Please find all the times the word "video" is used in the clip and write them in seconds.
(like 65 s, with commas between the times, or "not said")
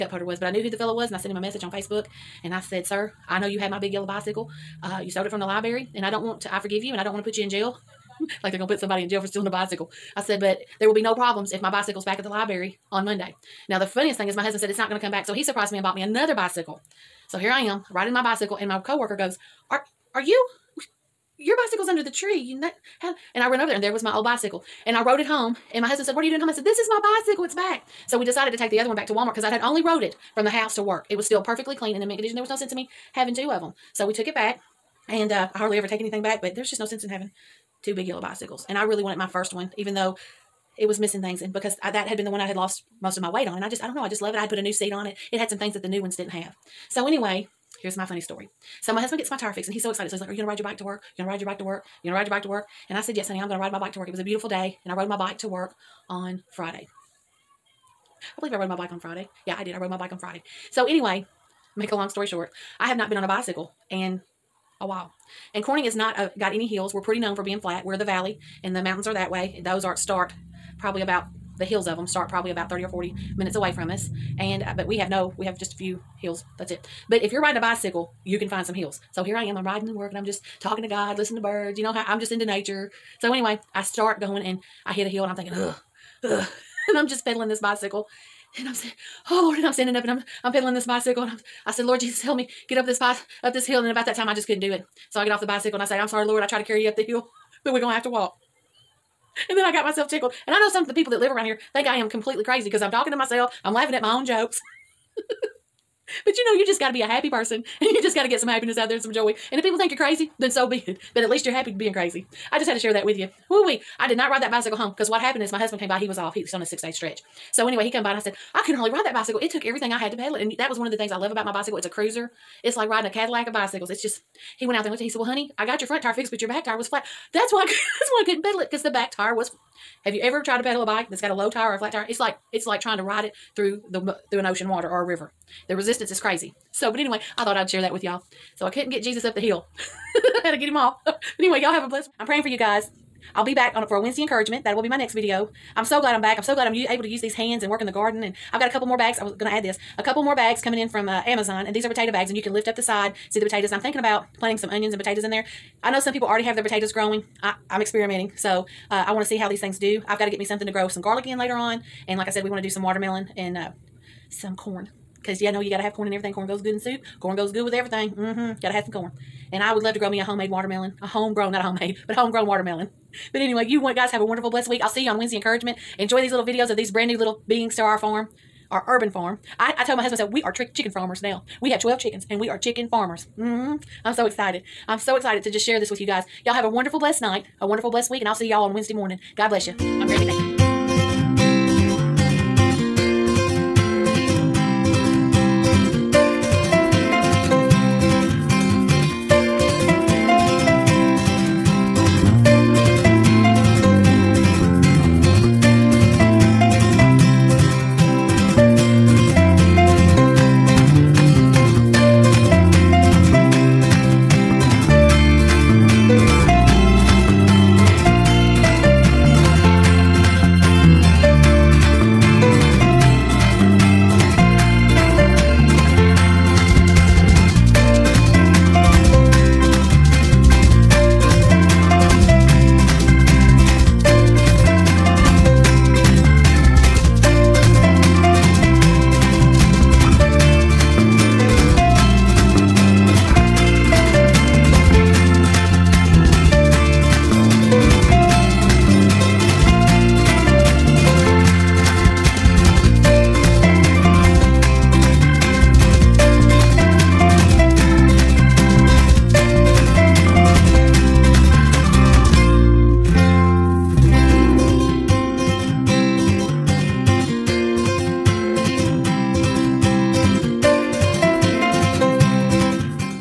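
145 s, 176 s.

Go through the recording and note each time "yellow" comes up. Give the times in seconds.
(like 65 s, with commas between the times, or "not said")
3 s, 38 s.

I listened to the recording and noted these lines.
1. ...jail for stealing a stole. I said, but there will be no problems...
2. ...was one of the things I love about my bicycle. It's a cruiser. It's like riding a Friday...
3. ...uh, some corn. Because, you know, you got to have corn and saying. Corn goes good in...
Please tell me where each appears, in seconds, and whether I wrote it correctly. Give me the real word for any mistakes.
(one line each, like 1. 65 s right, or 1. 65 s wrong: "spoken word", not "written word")
1. 9 s wrong: "bicycle", not "stole"
2. 120 s wrong: "Cadillac", not "Friday"
3. 163 s wrong: "everything", not "saying".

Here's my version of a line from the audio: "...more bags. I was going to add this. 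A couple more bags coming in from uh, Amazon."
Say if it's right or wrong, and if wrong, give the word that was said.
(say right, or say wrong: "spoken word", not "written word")
right.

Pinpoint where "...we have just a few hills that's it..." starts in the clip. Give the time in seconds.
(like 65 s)
75 s.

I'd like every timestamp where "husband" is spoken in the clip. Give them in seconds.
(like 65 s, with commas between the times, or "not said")
14 s, 25 s, 48 s, 115 s, 180 s.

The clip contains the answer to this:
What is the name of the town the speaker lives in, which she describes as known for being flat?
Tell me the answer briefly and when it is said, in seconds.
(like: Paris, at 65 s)
Corning, at 65 s.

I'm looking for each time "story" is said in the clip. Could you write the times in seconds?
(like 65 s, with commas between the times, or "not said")
48 s, 62 s.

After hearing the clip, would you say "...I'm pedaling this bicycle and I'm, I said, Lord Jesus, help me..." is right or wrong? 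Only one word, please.
right.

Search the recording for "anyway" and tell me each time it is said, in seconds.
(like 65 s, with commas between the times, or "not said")
47 s, 60 s, 83 s, 117 s, 136 s, 141 s, 173 s.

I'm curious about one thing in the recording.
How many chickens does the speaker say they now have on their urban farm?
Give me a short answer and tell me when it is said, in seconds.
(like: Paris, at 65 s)
12, at 181 s.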